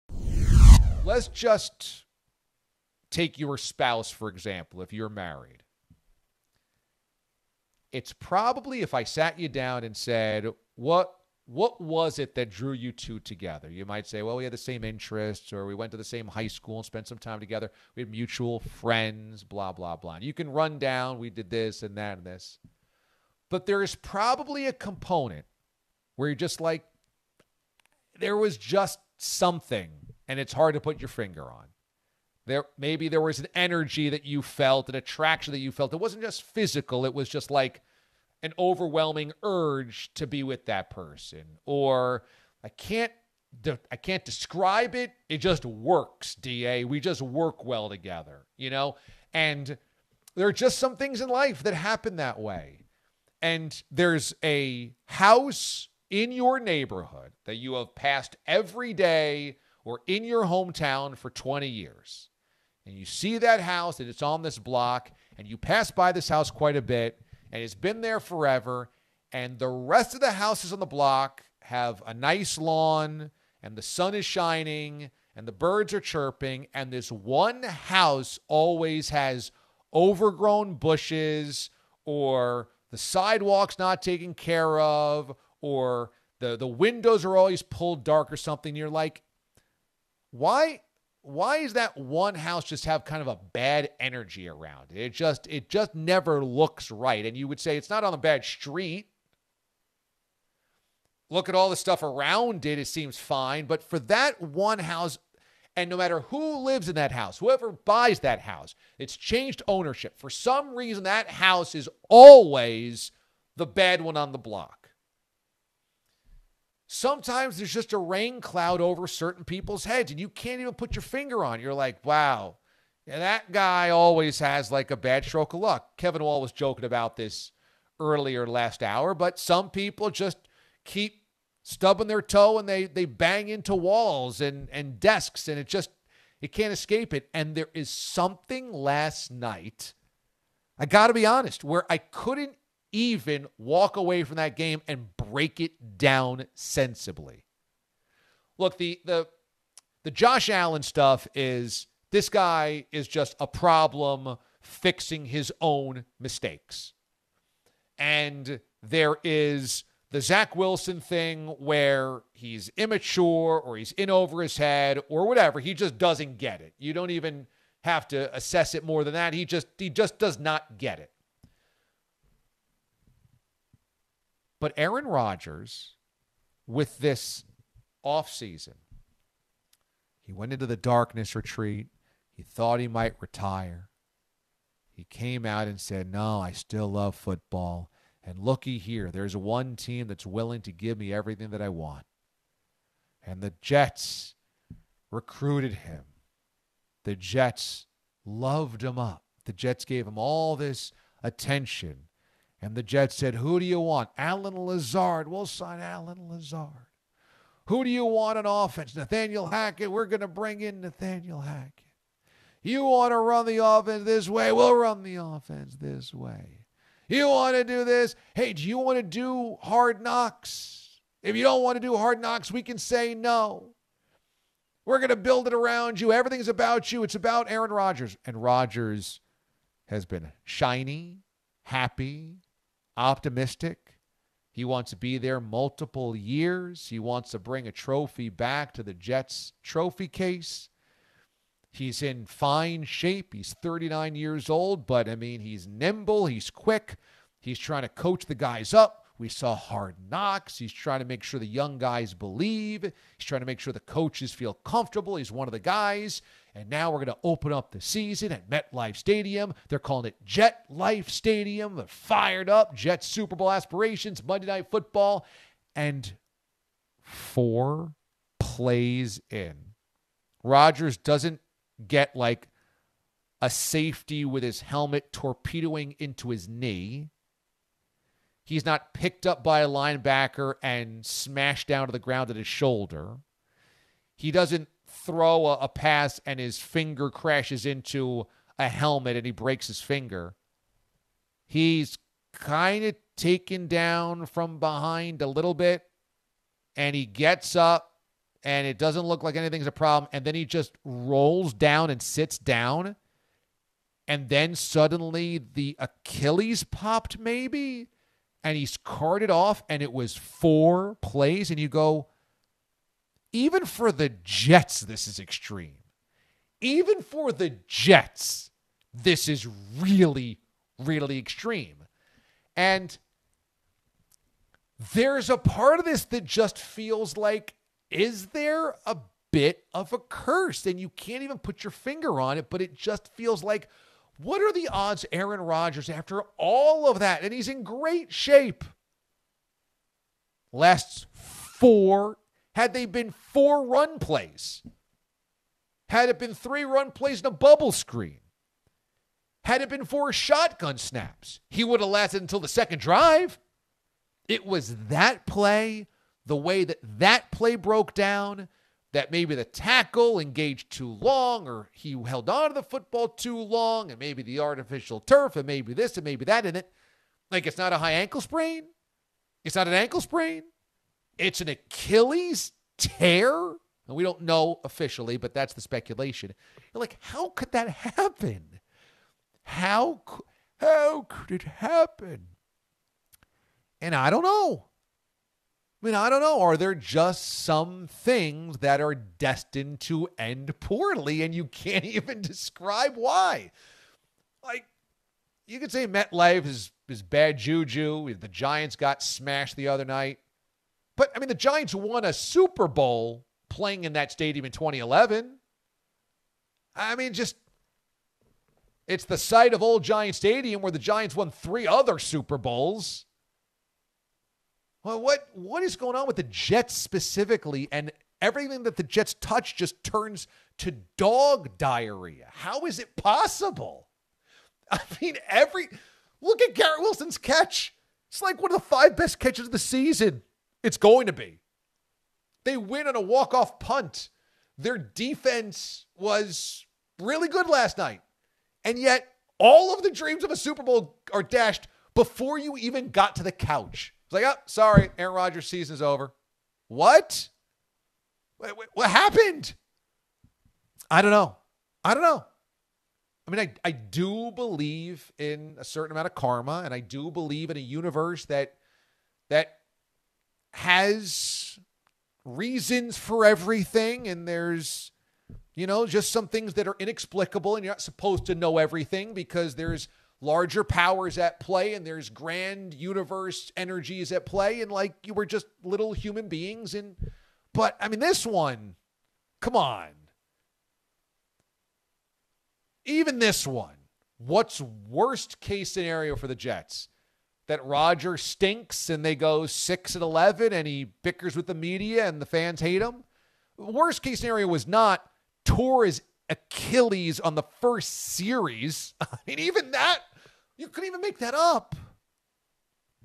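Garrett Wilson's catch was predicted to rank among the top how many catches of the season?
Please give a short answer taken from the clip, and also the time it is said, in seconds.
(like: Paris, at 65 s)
5, at 428 s.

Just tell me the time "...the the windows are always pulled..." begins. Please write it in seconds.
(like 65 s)
86 s.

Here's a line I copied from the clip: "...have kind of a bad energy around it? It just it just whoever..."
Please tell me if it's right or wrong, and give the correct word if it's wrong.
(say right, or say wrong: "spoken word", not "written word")
wrong: "never", not "whoever".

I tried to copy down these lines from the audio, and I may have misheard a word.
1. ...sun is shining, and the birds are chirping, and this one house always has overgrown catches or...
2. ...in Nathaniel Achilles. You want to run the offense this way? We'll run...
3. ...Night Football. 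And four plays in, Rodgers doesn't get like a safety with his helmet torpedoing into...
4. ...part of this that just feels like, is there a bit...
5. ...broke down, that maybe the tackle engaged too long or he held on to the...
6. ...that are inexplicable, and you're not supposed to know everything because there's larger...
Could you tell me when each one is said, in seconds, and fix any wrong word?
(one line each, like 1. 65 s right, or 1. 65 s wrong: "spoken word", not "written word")
1. 73 s wrong: "bushes", not "catches"
2. 210 s wrong: "Hackett", not "Achilles"
3. 264 s right
4. 325 s right
5. 357 s right
6. 466 s right.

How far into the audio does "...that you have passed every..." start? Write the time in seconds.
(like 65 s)
57 s.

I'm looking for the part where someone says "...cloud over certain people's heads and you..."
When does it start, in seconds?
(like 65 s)
118 s.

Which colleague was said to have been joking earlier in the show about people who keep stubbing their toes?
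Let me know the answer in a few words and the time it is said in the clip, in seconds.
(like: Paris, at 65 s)
Kevin Wall, at 125 s.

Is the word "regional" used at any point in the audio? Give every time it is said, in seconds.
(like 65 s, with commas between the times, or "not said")
not said.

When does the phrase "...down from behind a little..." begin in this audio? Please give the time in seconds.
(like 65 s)
293 s.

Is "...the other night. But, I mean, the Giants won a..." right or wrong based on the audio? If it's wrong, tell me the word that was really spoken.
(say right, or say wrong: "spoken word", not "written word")
right.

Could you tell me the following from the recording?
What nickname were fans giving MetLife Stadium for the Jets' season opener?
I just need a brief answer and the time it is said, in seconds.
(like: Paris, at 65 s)
Jet Life Stadium, at 260 s.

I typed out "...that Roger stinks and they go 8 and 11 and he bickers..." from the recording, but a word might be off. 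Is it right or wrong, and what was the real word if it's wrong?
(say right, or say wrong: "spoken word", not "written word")
wrong: "6", not "8".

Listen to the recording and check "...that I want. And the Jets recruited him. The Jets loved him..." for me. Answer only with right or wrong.
right.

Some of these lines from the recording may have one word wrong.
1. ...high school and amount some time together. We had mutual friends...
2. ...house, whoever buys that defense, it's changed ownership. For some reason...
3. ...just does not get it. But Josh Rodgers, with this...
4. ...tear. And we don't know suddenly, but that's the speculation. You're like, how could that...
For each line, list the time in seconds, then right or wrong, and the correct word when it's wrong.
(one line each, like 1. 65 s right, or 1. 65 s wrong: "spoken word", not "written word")
1. 16 s wrong: "spent", not "amount"
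2. 107 s wrong: "house", not "defense"
3. 169 s wrong: "Aaron", not "Josh"
4. 372 s wrong: "officially", not "suddenly".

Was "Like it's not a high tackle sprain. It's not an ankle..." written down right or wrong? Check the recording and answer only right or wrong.
wrong.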